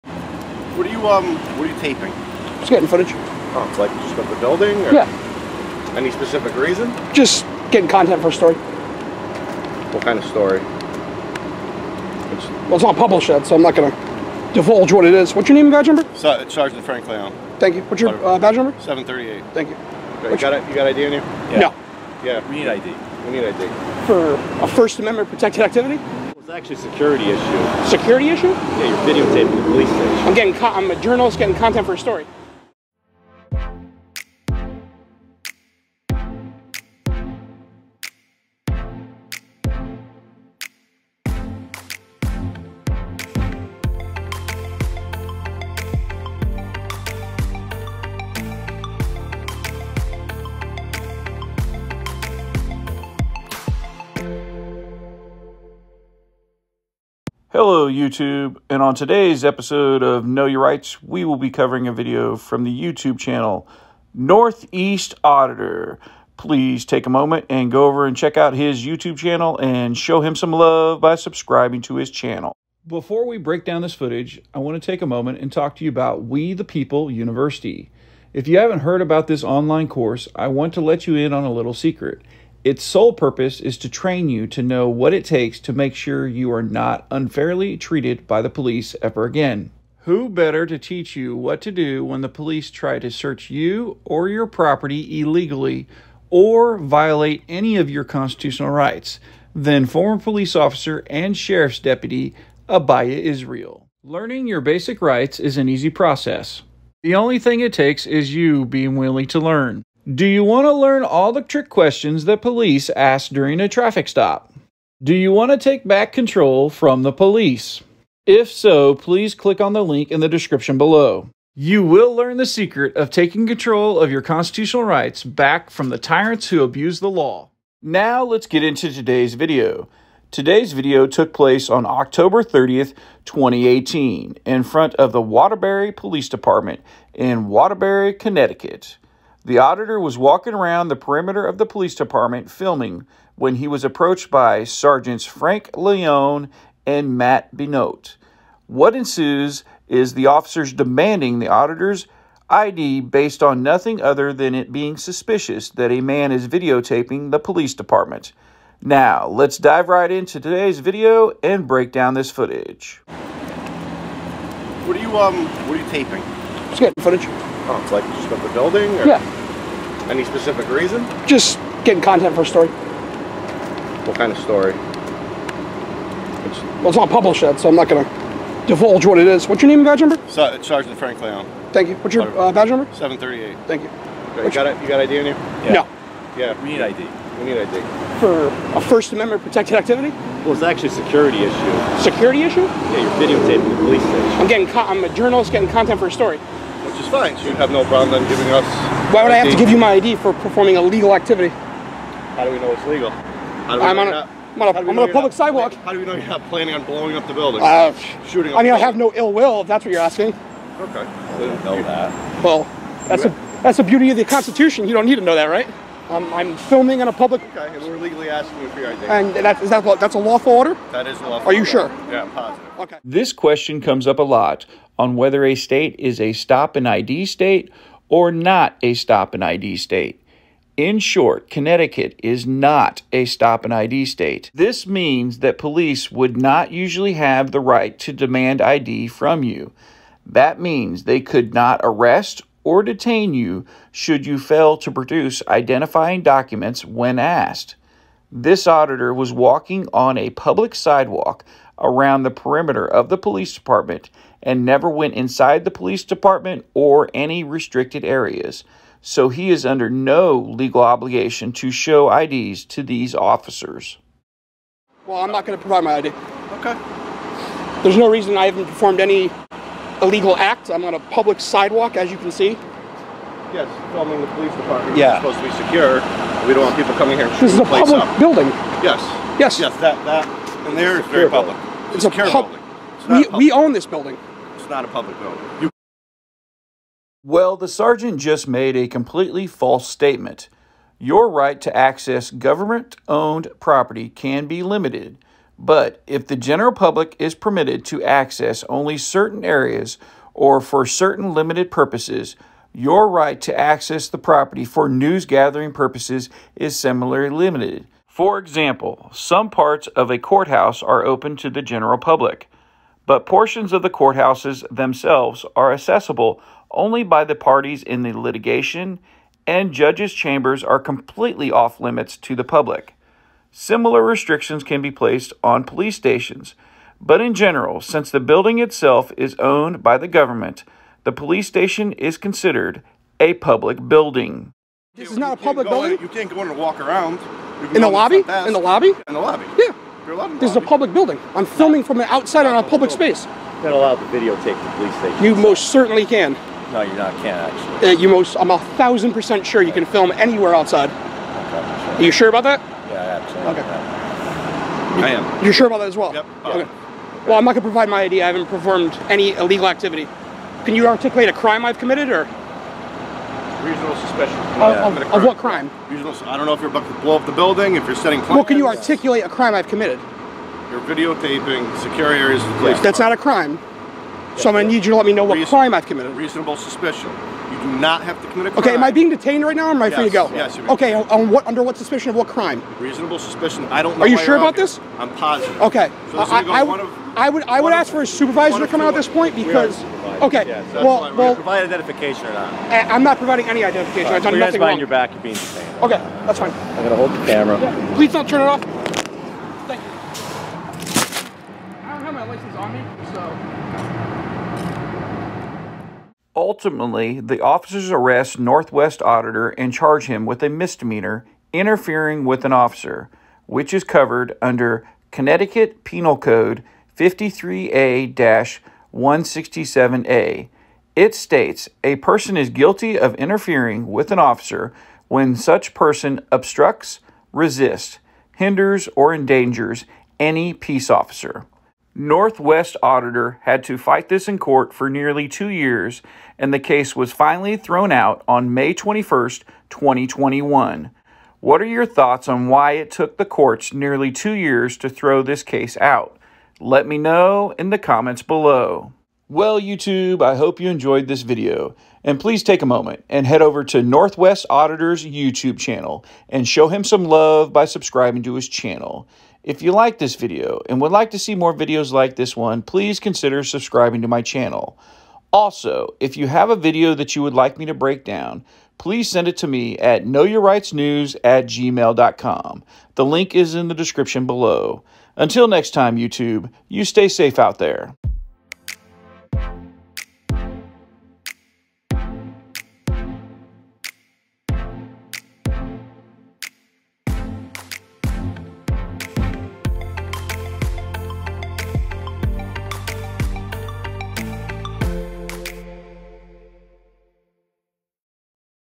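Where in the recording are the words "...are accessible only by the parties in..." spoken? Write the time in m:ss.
5:15.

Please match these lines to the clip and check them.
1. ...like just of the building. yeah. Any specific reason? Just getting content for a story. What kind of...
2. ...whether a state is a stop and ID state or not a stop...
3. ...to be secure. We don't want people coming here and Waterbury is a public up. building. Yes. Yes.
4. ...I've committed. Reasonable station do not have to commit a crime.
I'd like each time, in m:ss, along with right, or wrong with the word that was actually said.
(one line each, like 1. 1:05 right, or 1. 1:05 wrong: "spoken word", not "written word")
1. 0:03 right
2. 3:45 right
3. 4:35 wrong: "This", not "Waterbury"
4. 6:15 wrong: "suspicion", not "station".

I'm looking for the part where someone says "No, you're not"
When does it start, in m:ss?
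5:46.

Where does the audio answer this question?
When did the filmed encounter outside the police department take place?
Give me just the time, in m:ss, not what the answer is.
2:11.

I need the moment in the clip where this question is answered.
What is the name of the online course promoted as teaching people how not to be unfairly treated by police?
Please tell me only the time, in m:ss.
1:16.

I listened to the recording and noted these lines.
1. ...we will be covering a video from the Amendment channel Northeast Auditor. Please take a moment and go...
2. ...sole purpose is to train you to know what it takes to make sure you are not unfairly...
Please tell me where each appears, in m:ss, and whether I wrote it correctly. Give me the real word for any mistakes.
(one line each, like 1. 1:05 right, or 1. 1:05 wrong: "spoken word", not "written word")
1. 1:01 wrong: "YouTube", not "Amendment"
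2. 1:22 right.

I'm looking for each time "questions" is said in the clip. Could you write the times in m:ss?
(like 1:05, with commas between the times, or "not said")
1:51, 3:43.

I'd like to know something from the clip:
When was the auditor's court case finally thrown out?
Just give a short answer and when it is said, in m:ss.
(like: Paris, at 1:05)
May 21st, 2021, at 7:18.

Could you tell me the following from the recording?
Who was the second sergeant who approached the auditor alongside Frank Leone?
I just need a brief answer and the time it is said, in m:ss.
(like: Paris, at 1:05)
Matt Benote, at 2:27.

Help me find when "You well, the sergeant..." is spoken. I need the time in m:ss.
4:45.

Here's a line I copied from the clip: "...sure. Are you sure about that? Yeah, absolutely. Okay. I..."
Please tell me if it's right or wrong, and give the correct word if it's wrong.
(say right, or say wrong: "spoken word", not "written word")
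right.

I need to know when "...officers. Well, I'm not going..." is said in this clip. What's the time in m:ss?
4:23.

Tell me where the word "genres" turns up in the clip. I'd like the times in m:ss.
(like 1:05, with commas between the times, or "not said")
not said.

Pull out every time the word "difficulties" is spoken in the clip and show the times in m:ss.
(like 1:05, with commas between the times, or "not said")
not said.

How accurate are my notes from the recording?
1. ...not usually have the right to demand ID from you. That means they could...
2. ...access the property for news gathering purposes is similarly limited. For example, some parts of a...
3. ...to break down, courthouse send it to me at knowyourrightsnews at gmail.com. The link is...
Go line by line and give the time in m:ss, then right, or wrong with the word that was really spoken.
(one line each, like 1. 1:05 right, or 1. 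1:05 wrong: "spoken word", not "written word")
1. 3:56 right
2. 5:03 right
3. 7:47 wrong: "please", not "courthouse".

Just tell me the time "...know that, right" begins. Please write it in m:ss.
3:35.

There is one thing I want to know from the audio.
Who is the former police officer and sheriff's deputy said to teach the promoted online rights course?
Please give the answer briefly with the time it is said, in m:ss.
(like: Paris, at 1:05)
Abiyah Israel, at 1:42.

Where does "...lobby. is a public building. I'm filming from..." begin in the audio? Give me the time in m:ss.
5:40.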